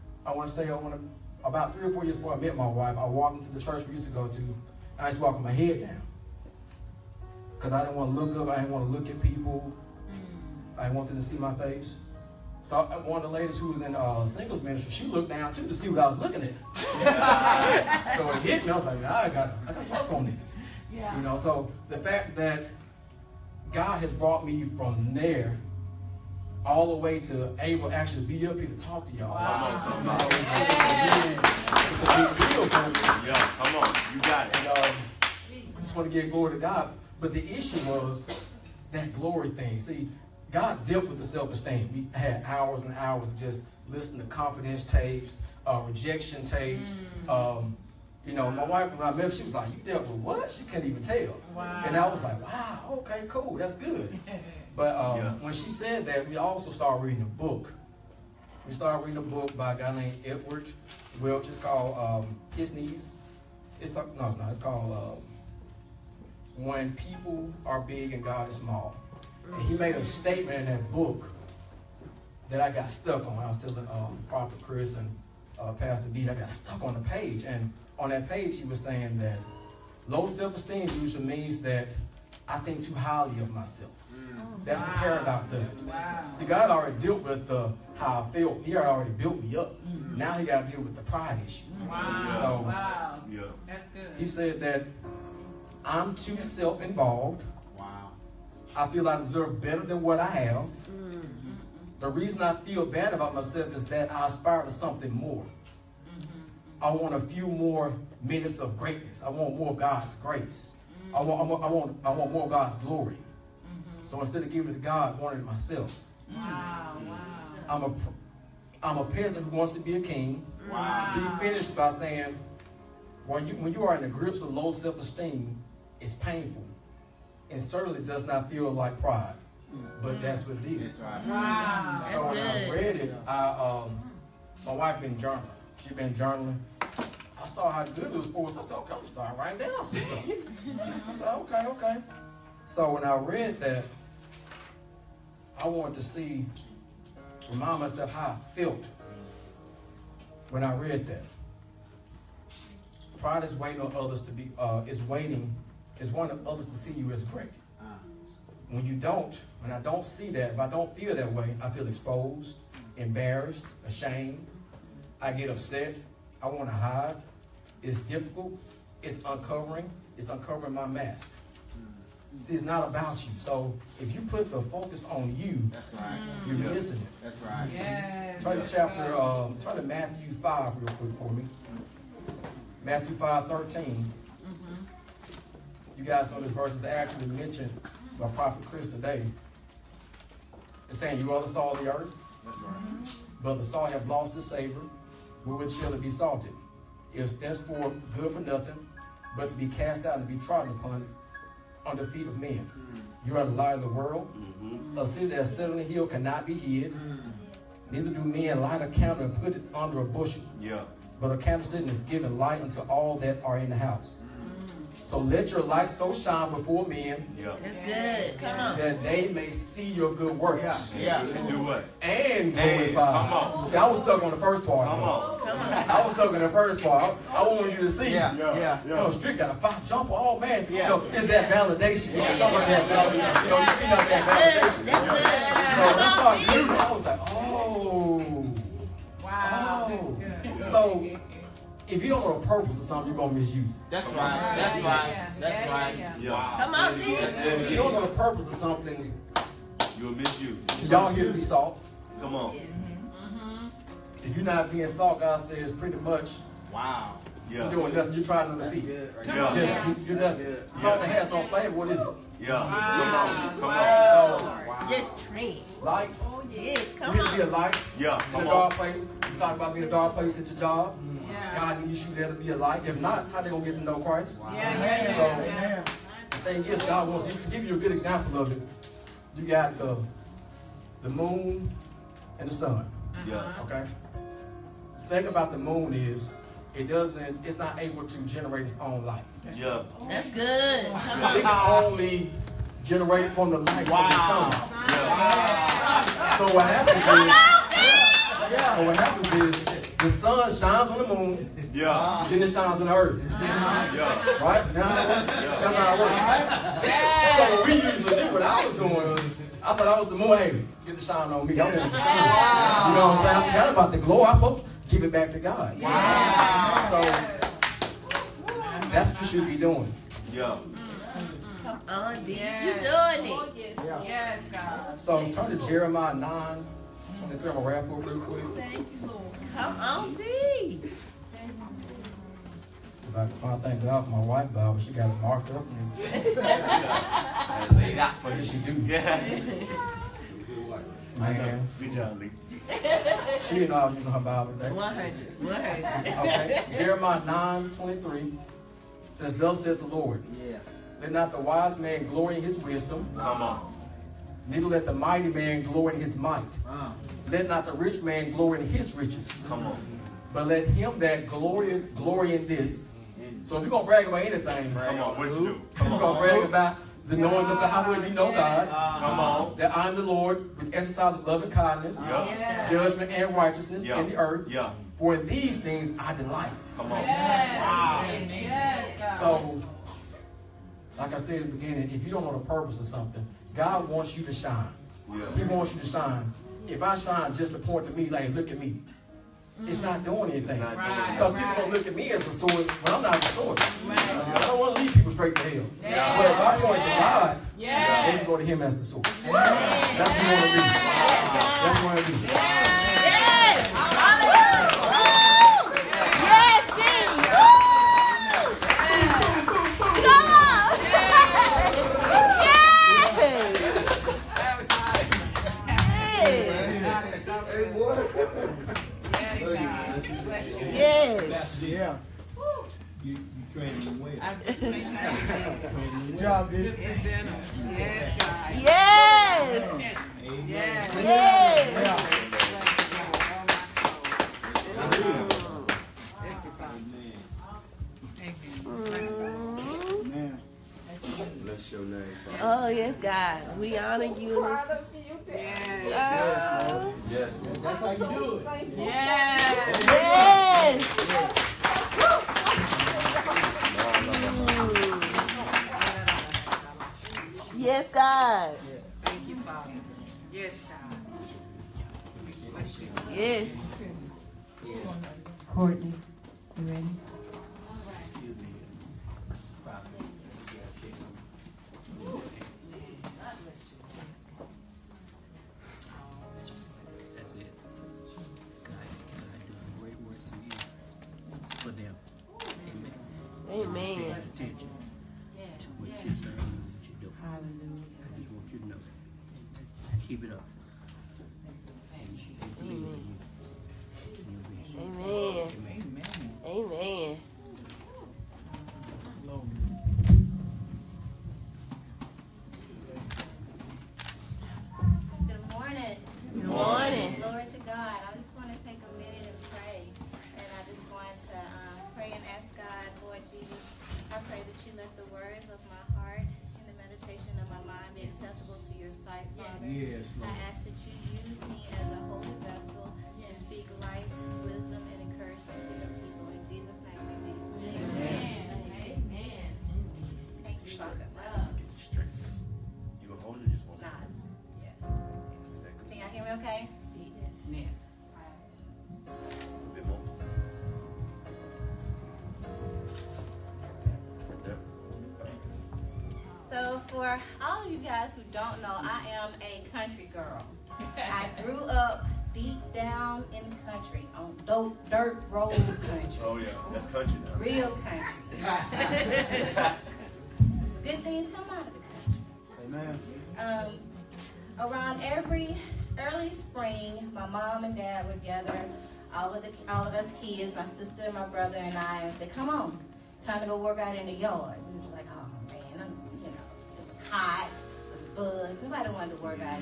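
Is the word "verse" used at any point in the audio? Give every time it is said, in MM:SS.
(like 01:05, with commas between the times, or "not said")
03:06.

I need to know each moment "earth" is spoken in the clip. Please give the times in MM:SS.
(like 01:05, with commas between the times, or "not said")
03:11, 05:02, 06:14.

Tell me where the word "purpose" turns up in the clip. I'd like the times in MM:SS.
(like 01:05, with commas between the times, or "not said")
04:02, 04:08, 06:22.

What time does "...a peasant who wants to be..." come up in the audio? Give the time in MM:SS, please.
01:58.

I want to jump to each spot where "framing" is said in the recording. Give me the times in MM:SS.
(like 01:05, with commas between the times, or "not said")
not said.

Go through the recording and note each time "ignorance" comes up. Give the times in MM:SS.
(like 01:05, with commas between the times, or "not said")
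not said.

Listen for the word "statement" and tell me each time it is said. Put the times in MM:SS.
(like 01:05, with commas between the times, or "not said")
01:10.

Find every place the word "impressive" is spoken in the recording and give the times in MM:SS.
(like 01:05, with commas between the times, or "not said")
not said.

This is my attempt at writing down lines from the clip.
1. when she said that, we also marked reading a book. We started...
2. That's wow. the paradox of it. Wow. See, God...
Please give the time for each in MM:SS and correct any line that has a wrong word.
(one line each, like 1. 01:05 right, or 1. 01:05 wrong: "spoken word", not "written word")
1. 00:55 wrong: "started", not "marked"
2. 01:24 right.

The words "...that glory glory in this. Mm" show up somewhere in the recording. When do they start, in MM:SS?
06:00.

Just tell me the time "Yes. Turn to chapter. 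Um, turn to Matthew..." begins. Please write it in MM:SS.
02:57.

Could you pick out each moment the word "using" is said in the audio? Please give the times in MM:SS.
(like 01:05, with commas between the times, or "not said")
05:43.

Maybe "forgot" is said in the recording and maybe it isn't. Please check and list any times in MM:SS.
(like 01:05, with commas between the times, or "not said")
05:13.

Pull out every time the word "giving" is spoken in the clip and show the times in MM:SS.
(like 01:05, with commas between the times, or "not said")
01:54.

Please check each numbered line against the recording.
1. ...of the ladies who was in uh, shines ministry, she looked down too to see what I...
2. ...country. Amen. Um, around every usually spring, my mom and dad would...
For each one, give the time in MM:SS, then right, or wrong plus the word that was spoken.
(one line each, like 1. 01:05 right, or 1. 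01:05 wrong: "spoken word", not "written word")
1. 00:13 wrong: "singles", not "shines"
2. 09:22 wrong: "early", not "usually".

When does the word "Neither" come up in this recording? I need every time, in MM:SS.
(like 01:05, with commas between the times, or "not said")
03:27, 05:54.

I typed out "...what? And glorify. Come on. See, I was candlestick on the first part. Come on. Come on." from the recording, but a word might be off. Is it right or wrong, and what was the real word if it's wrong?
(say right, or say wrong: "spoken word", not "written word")
wrong: "stuck", not "candlestick".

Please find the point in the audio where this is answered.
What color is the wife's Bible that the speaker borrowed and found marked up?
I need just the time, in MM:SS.
05:34.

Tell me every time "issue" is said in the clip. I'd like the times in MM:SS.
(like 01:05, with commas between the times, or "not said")
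00:37, 01:31.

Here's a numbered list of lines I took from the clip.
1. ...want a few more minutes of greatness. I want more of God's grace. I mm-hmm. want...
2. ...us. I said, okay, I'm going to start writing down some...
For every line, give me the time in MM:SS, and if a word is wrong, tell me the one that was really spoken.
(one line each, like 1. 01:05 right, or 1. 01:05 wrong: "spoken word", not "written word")
1. 01:46 right
2. 02:18 right.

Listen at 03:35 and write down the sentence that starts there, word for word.
So let your light so shine before men.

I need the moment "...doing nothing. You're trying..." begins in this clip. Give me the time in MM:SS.
04:17.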